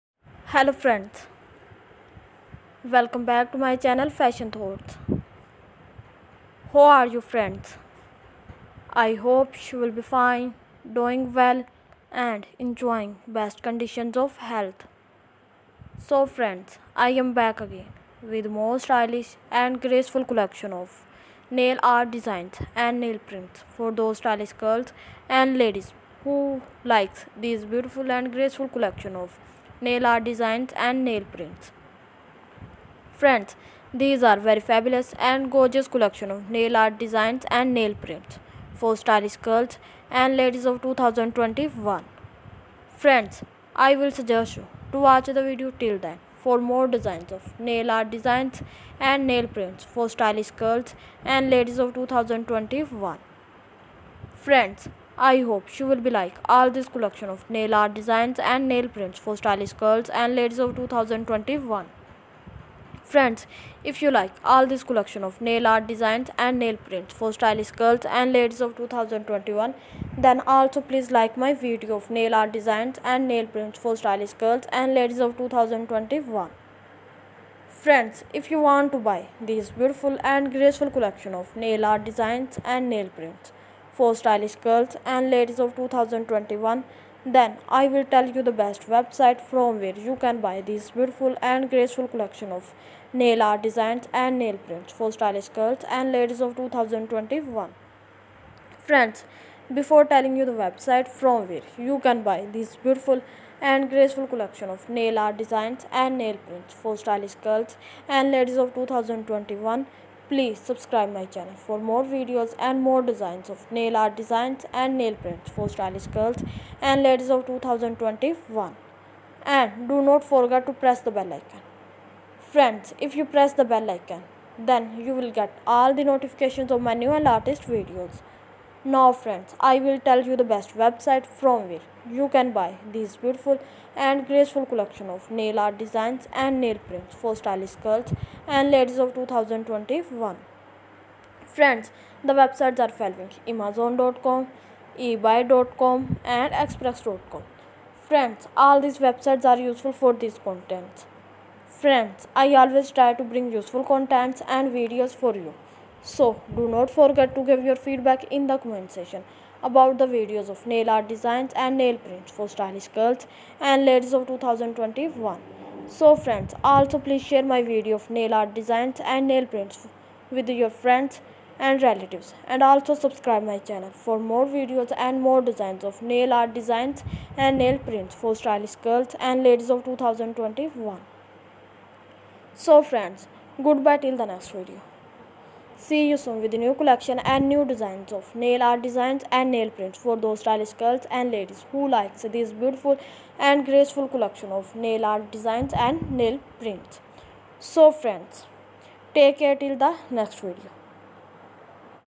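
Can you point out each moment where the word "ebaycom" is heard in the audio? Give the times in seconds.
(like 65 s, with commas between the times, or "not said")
144 s.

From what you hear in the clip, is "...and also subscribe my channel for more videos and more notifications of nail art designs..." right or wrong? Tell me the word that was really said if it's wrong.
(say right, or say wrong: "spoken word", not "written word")
wrong: "designs", not "notifications".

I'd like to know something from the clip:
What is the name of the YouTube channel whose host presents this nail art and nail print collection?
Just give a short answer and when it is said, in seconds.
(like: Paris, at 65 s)
Fashion Thoughts, at 4 s.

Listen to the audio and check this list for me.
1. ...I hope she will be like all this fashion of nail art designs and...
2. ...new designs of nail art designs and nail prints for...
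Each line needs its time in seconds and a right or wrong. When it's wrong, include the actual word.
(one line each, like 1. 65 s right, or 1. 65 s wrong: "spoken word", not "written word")
1. 55 s wrong: "collection", not "fashion"
2. 187 s right.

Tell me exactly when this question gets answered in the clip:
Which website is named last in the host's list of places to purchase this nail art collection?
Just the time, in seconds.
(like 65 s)
146 s.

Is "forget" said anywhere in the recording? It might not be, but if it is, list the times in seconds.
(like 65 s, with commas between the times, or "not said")
120 s, 156 s.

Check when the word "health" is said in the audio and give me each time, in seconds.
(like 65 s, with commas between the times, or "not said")
14 s.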